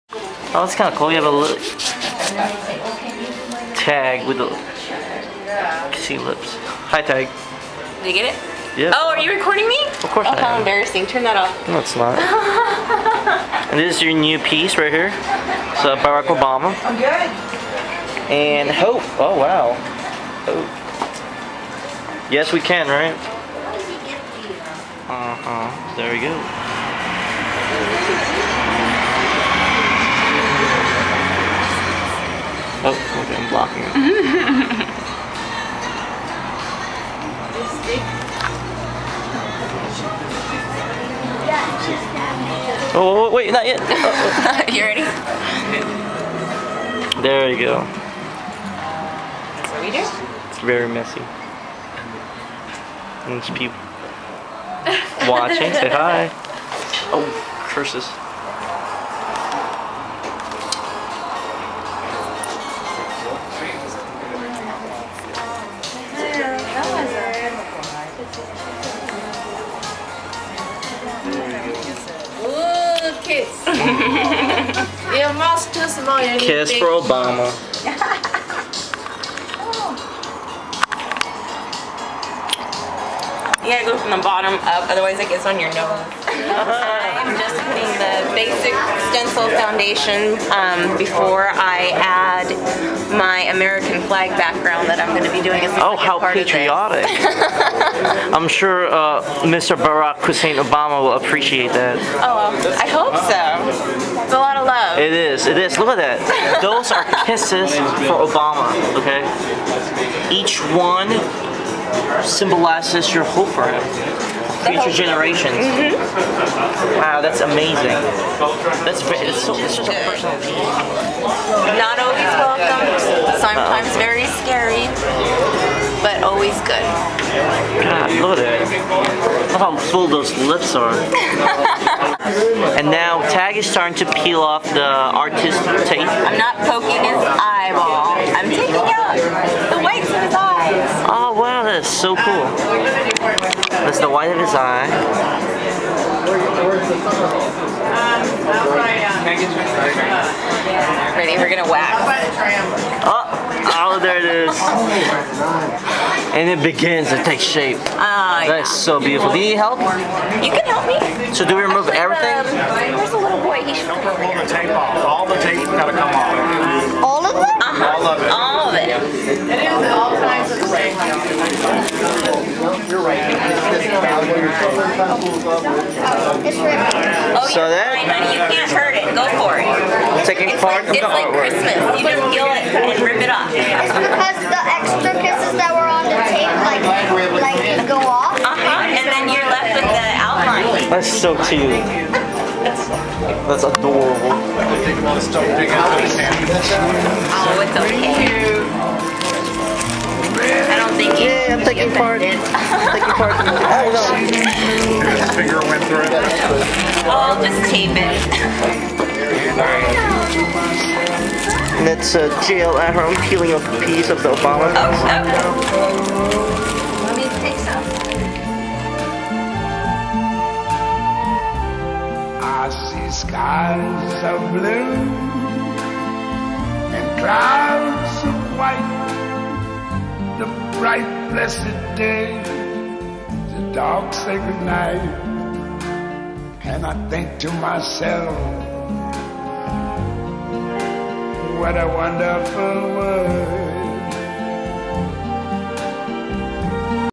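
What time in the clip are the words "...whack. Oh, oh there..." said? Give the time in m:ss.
2:31.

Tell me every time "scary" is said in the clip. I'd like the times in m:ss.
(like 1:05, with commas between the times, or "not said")
2:04.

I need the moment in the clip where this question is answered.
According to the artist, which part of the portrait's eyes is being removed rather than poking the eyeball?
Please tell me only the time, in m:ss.
2:19.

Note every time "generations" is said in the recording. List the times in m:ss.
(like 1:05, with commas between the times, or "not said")
1:54.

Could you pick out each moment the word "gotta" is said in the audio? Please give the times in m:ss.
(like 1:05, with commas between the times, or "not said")
1:23, 2:45.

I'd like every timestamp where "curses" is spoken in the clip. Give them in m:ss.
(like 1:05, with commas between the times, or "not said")
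0:57.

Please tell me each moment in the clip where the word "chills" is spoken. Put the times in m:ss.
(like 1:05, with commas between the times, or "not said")
not said.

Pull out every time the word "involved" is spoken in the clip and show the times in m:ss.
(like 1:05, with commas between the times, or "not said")
not said.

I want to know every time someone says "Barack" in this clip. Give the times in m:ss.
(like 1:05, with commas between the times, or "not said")
0:16, 1:39.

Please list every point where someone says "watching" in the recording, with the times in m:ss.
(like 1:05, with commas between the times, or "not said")
0:55.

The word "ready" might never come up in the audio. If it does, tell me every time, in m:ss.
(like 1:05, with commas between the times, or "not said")
0:44, 2:31.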